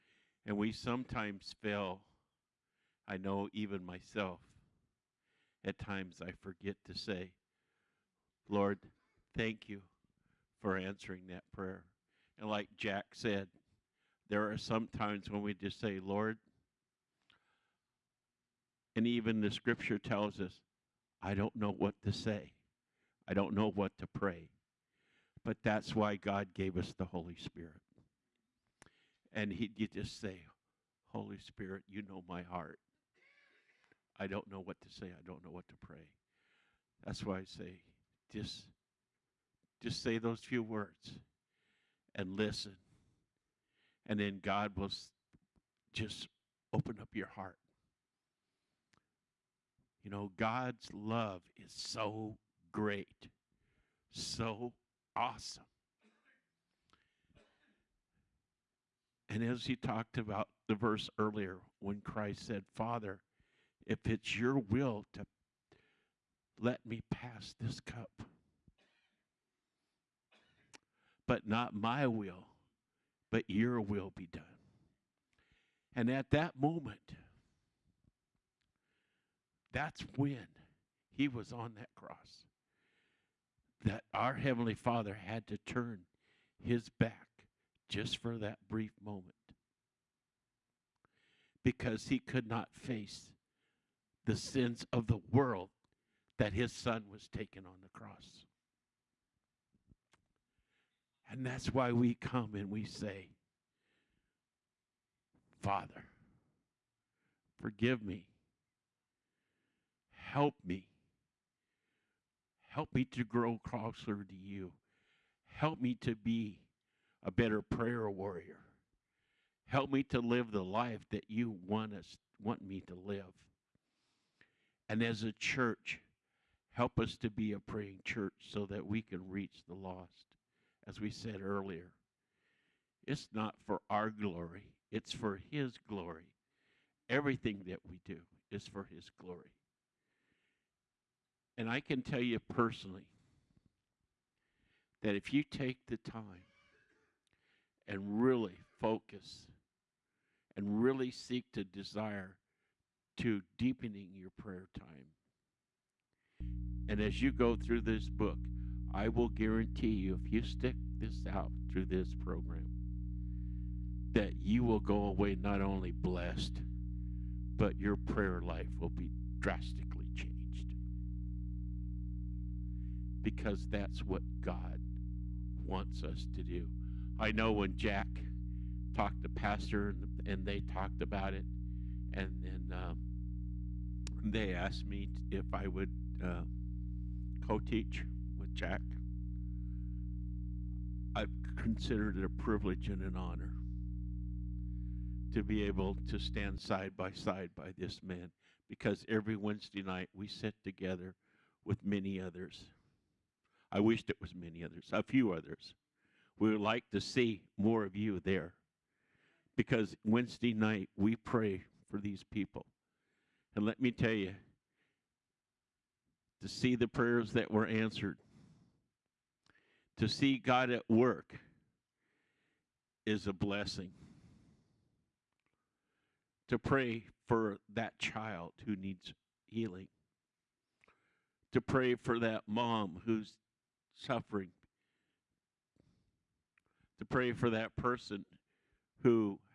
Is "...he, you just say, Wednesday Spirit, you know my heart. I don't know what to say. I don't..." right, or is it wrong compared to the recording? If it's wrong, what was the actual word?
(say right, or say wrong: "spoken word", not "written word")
wrong: "Holy", not "Wednesday".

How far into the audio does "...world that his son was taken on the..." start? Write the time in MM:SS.
01:35.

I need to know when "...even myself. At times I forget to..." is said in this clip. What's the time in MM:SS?
00:03.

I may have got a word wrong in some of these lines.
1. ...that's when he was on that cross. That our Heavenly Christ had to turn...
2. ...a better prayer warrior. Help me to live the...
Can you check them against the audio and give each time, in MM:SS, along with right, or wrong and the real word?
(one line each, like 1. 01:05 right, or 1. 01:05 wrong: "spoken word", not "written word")
1. 01:19 wrong: "Father", not "Christ"
2. 01:57 right.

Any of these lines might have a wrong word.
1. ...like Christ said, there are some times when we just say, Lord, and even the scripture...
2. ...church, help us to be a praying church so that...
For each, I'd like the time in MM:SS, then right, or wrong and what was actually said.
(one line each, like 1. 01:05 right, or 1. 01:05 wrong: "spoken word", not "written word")
1. 00:12 wrong: "Jack", not "Christ"
2. 02:05 right.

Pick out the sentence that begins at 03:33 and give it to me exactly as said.
And let me tell you, to see the prayers that were answered, to see God at work is a blessing.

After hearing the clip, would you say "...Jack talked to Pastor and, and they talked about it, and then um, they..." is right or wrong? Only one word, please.
right.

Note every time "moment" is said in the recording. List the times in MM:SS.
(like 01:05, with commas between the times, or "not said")
01:16, 01:29.